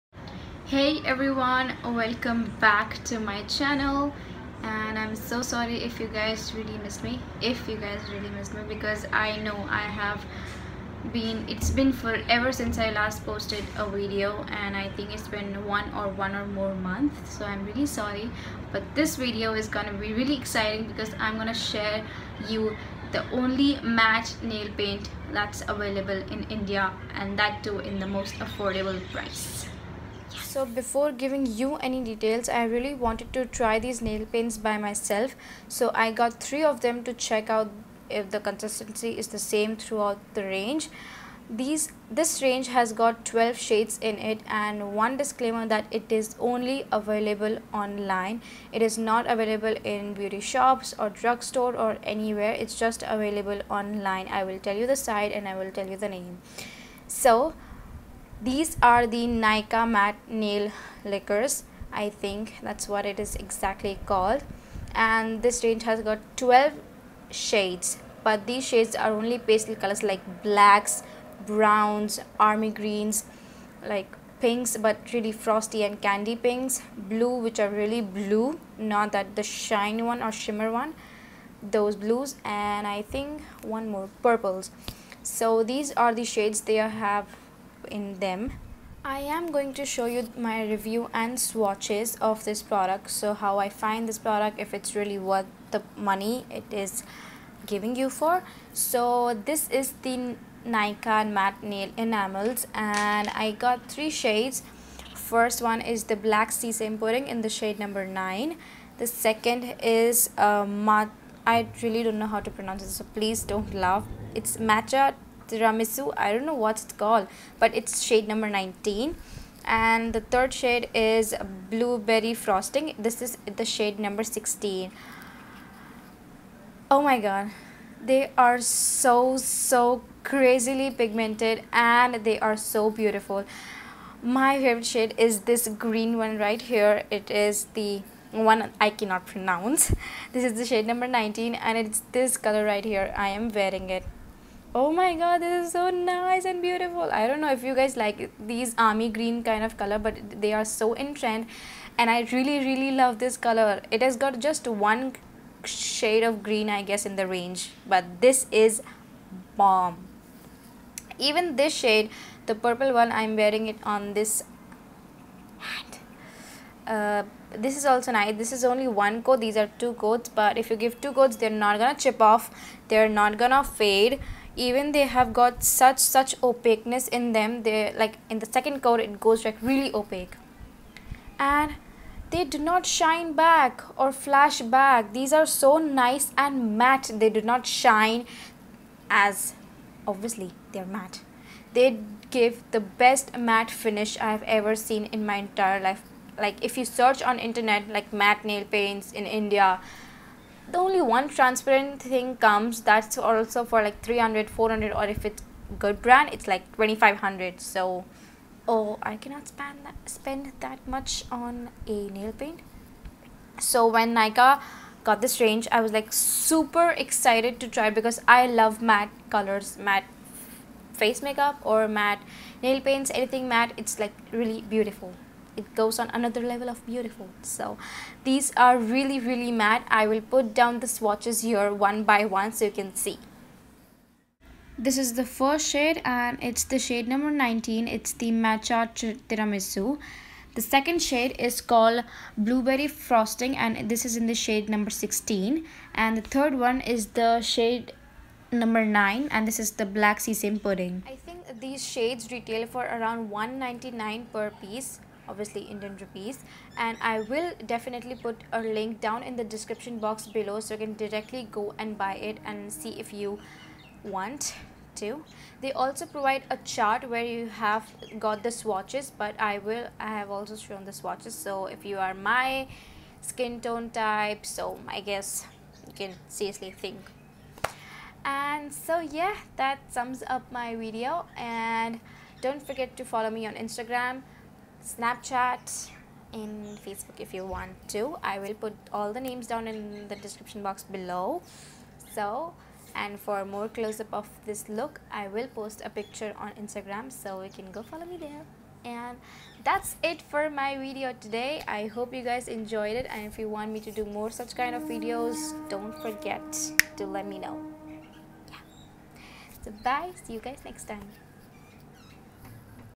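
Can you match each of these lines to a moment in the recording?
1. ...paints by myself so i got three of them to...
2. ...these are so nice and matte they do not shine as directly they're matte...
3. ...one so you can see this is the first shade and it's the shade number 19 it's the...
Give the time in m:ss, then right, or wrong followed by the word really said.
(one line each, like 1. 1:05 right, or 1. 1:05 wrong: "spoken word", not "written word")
1. 0:34 right
2. 3:05 wrong: "obviously", not "directly"
3. 3:52 right.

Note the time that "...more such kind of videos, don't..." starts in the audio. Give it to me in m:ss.
5:04.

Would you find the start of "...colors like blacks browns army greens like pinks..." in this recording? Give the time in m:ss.
1:09.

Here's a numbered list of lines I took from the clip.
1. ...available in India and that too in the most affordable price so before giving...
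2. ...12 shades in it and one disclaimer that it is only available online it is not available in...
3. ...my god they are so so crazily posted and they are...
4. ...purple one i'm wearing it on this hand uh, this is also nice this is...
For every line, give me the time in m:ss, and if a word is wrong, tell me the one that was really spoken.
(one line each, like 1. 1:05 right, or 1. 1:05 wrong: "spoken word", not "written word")
1. 0:25 right
2. 0:43 right
3. 2:07 wrong: "pigmented", not "posted"
4. 2:42 right.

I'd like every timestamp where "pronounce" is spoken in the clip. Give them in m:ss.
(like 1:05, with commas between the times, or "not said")
1:52, 2:19.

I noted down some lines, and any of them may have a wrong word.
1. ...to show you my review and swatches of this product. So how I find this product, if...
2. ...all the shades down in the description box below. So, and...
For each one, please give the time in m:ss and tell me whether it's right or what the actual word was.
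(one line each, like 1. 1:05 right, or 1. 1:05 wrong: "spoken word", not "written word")
1. 1:29 right
2. 4:48 wrong: "names", not "shades".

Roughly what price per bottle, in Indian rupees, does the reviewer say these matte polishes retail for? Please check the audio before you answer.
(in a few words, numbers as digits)
199.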